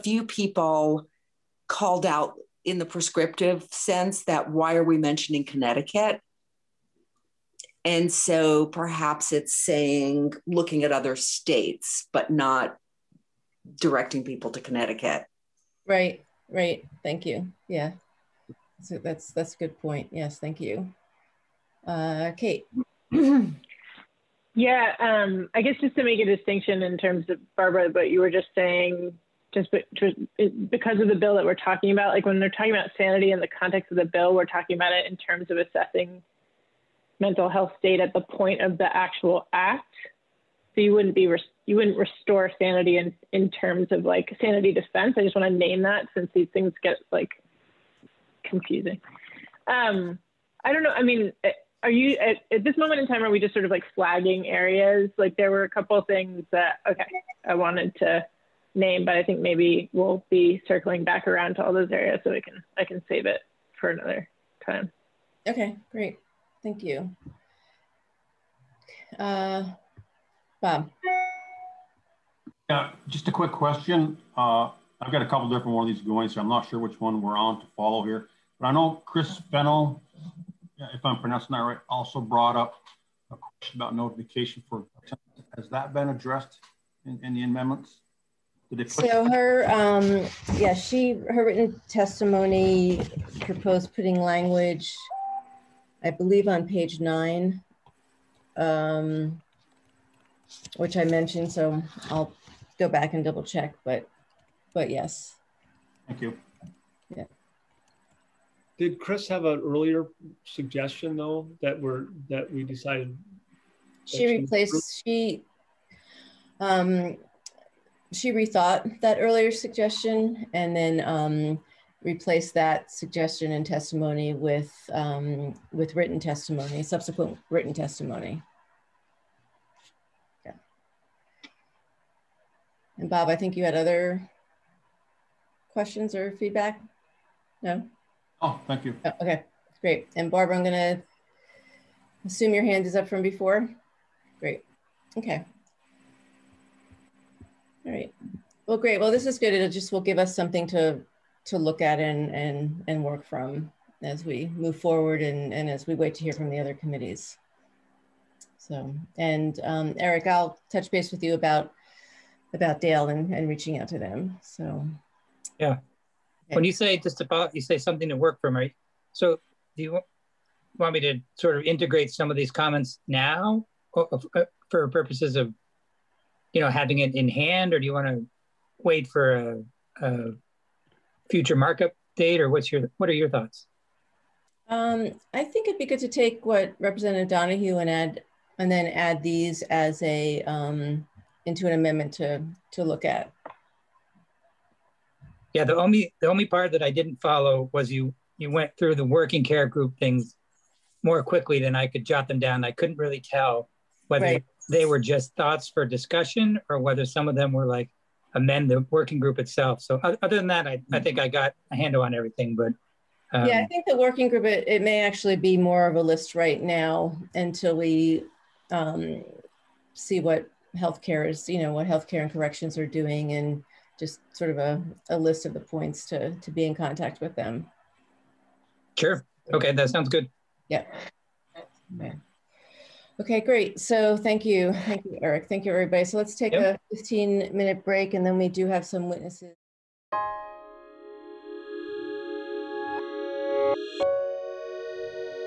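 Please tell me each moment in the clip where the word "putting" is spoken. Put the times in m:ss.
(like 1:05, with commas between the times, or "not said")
1:33.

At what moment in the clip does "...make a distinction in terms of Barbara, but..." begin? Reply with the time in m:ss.
0:26.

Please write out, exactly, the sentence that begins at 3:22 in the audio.
I couldn't really tell whether right.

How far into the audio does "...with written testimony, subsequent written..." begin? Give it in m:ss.
2:05.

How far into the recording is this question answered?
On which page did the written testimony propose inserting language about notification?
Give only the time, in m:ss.
1:36.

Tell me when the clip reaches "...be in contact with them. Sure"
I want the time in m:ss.
3:46.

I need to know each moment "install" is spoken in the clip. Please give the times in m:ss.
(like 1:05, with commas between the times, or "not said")
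not said.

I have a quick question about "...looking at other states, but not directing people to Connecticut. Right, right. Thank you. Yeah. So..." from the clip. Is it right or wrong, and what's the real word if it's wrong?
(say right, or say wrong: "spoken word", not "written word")
right.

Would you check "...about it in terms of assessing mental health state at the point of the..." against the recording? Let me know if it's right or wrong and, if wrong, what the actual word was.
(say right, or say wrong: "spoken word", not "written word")
right.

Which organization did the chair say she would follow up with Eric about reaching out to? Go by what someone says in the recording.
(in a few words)
DAIL.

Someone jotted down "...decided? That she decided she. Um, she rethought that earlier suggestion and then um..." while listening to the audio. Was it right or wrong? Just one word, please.
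wrong.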